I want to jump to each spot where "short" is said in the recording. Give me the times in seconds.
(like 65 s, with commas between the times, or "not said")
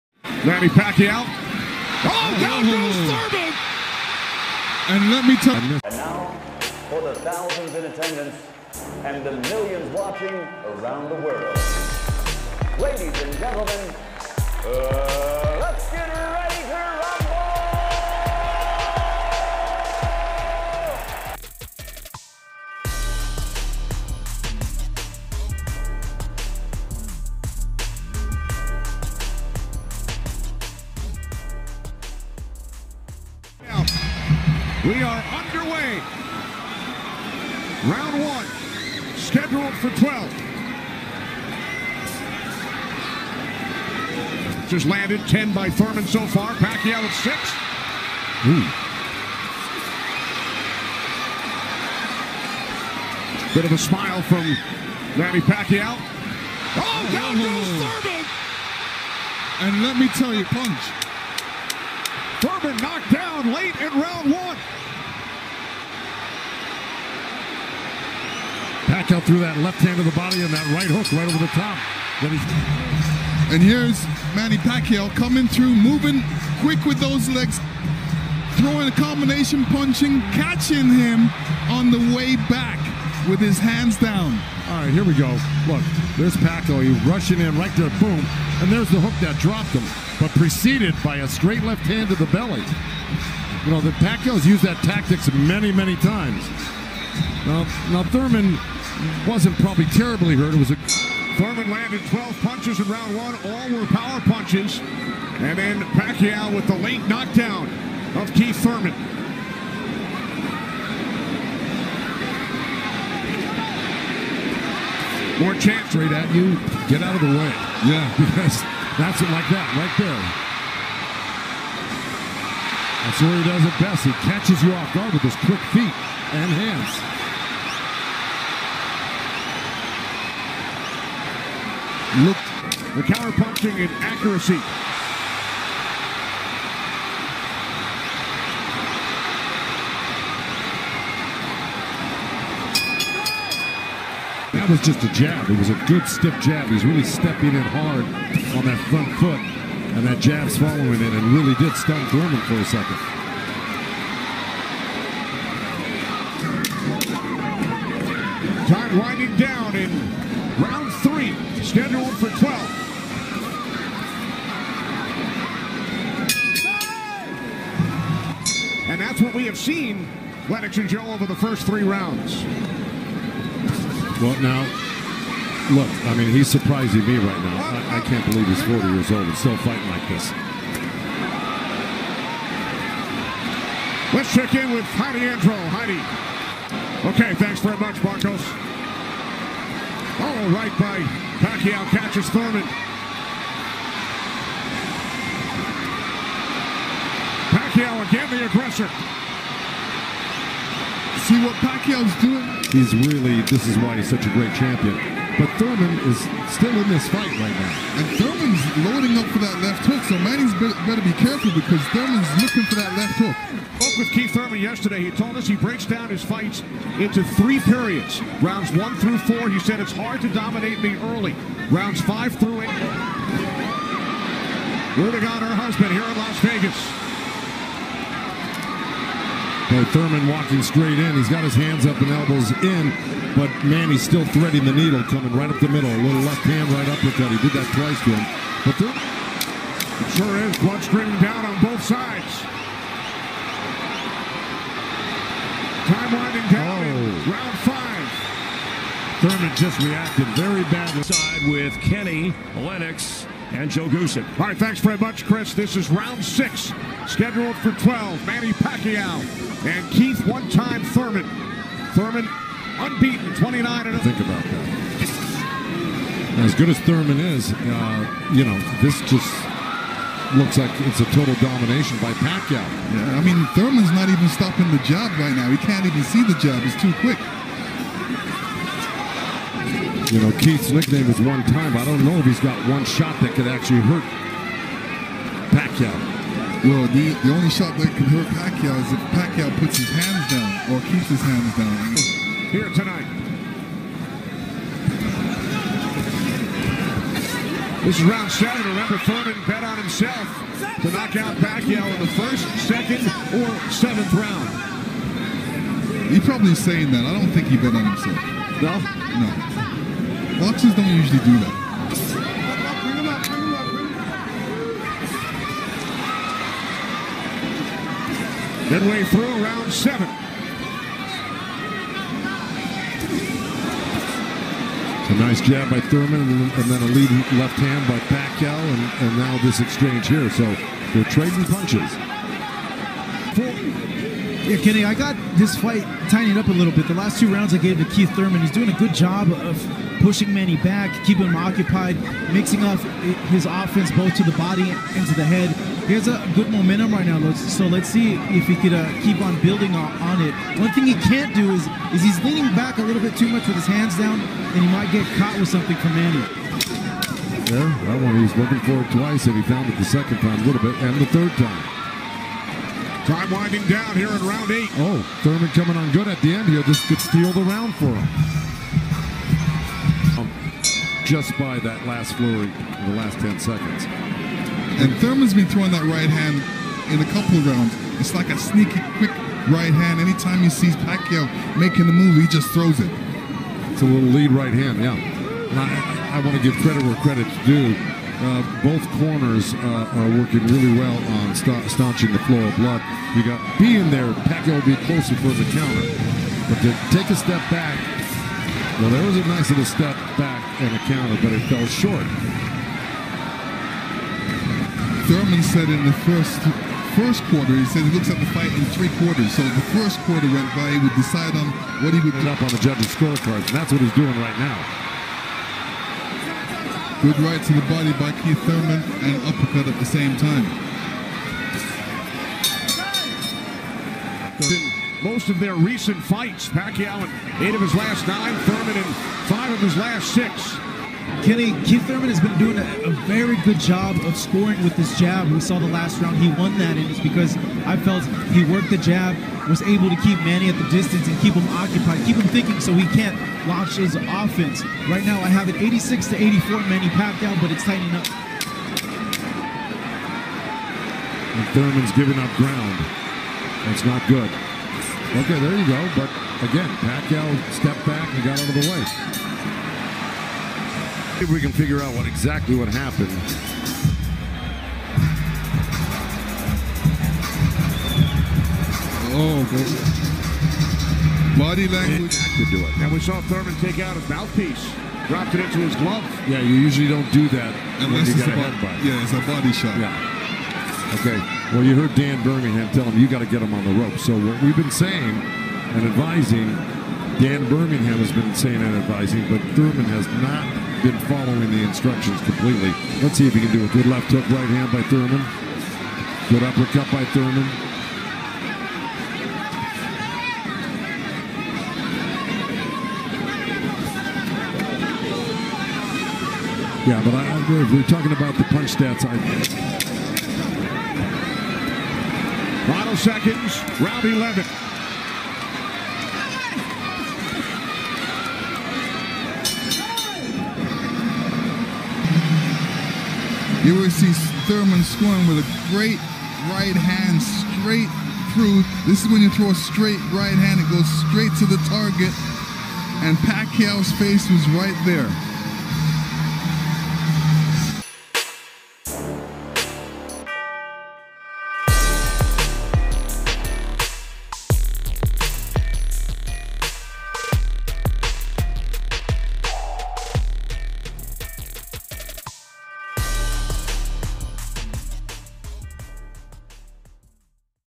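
401 s.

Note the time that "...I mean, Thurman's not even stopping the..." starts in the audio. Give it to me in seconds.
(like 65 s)
273 s.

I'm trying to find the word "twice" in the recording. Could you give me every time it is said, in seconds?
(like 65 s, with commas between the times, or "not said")
237 s, 358 s.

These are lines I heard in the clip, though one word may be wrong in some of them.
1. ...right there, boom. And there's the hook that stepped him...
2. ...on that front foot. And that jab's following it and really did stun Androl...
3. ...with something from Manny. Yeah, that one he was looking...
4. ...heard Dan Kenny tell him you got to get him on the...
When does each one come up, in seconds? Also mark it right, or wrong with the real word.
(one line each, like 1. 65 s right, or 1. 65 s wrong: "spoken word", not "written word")
1. 87 s wrong: "dropped", not "stepped"
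2. 148 s wrong: "Thurman", not "Androl"
3. 355 s right
4. 481 s wrong: "Birmingham", not "Kenny".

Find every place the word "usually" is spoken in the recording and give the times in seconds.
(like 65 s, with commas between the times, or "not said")
310 s, 476 s.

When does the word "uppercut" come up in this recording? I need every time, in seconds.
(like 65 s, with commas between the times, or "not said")
236 s, 419 s, 496 s.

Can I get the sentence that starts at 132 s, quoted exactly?
looked the counter punching and accuracy.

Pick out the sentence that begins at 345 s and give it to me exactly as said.
He has a good momentum right now, so let's see if he could uh, keep on building on it.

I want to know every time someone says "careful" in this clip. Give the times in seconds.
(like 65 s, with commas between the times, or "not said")
211 s.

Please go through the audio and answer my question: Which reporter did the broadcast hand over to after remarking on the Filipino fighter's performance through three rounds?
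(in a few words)
Heidi Androl.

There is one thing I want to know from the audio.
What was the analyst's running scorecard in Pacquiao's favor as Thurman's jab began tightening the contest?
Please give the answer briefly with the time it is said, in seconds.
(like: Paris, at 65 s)
86 to 84, at 445 s.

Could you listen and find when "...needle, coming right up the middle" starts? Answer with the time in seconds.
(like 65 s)
234 s.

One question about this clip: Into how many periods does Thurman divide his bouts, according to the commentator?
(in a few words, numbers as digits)
3.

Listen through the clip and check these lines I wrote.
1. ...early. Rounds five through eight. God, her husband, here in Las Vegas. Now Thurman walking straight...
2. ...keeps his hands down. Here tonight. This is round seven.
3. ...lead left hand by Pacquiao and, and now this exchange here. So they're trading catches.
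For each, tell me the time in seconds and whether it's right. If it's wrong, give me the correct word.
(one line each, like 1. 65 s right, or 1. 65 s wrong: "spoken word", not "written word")
1. 221 s right
2. 290 s right
3. 326 s wrong: "punches", not "catches".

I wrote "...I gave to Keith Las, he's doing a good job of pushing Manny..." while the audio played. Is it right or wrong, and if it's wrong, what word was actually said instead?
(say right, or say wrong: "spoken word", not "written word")
wrong: "Thurman", not "Las".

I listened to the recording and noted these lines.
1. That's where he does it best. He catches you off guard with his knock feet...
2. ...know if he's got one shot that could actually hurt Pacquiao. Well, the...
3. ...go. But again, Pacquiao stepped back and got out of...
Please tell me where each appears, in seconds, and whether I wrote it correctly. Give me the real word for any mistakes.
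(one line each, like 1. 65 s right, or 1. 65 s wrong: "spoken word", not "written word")
1. 123 s wrong: "quick", not "knock"
2. 282 s right
3. 455 s right.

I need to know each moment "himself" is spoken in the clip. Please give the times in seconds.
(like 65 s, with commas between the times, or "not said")
299 s, 307 s.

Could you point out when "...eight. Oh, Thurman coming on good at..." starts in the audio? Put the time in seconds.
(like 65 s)
364 s.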